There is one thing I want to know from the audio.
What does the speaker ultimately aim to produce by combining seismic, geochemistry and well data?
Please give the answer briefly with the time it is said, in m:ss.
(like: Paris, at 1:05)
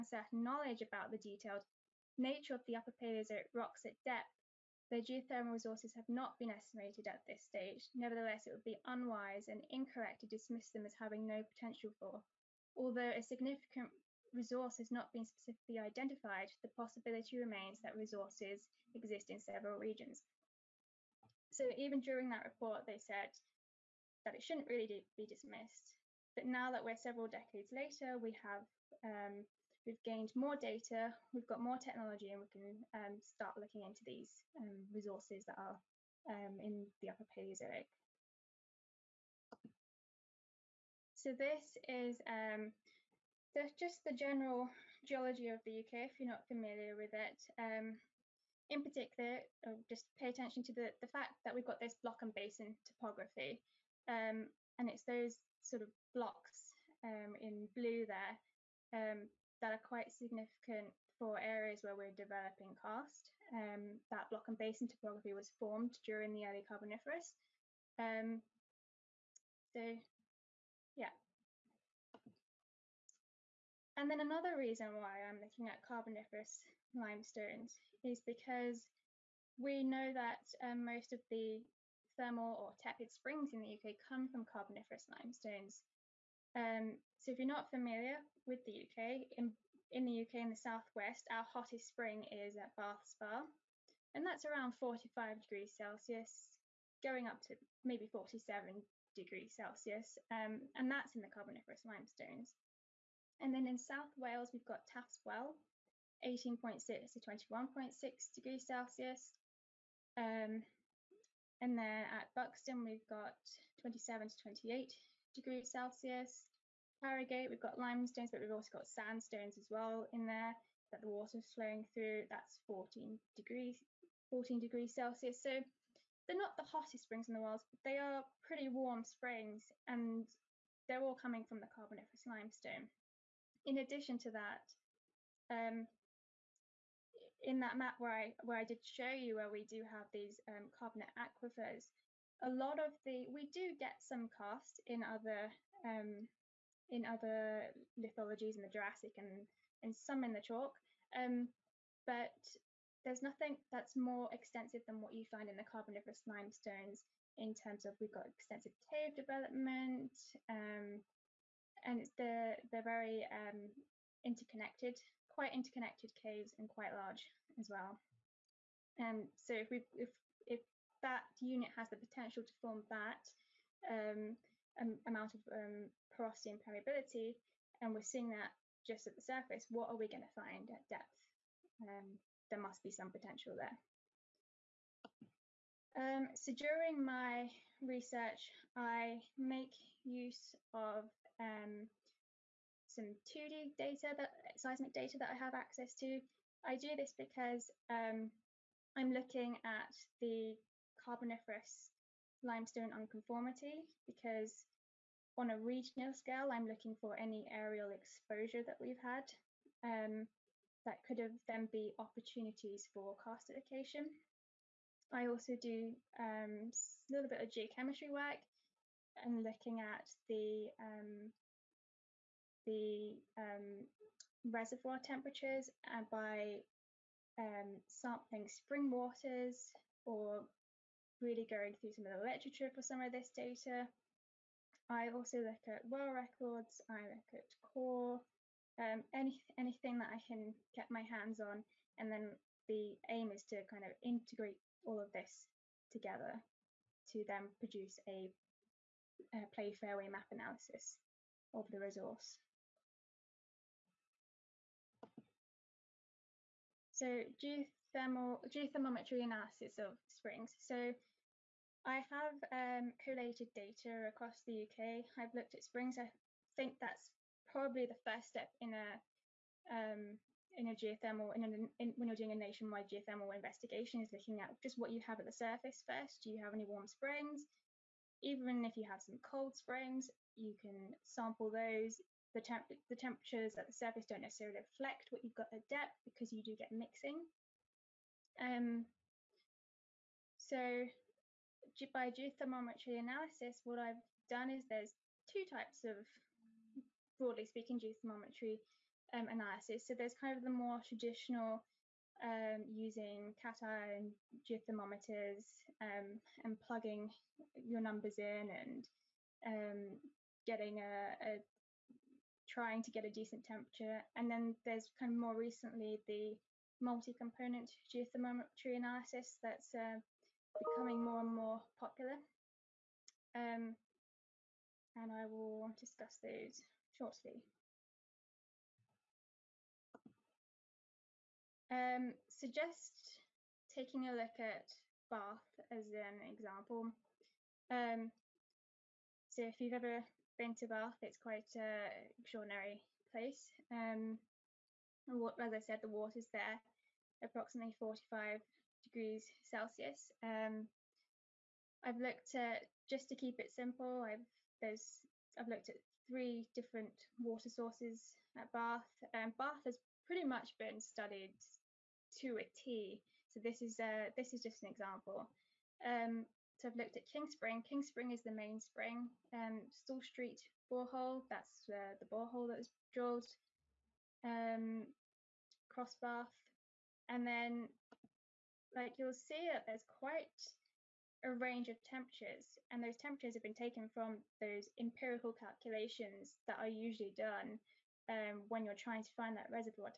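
play fairway map, at 4:09.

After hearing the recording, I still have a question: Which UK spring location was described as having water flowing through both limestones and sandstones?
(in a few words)
Harrogate.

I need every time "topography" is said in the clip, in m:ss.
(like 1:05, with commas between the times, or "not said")
0:52, 1:04.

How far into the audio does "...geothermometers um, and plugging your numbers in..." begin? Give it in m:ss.
5:04.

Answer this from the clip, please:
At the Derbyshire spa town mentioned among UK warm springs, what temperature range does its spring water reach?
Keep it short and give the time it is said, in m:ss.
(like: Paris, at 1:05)
27 to 28 degrees Celsius, at 1:53.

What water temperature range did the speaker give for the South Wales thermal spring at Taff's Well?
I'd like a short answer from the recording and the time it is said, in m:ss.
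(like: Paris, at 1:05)
18.6 to 21.6 degrees Celsius, at 1:46.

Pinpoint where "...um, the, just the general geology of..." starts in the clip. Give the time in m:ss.
0:42.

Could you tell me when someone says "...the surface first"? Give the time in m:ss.
4:35.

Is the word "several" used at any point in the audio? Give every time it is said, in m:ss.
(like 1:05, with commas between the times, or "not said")
0:19, 0:26.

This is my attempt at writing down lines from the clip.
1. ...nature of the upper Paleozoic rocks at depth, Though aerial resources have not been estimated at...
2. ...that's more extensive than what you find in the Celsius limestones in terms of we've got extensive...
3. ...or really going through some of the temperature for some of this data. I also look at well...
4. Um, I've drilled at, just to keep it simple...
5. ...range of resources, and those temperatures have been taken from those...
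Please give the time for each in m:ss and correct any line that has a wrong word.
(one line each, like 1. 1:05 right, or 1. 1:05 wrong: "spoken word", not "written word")
1. 0:02 wrong: "geothermal", not "aerial"
2. 2:33 wrong: "Carboniferous", not "Celsius"
3. 3:50 wrong: "literature", not "temperature"
4. 5:50 wrong: "looked", not "drilled"
5. 6:21 wrong: "temperatures", not "resources".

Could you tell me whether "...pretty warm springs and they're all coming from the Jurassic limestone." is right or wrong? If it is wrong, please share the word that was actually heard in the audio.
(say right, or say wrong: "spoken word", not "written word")
wrong: "Carboniferous", not "Jurassic".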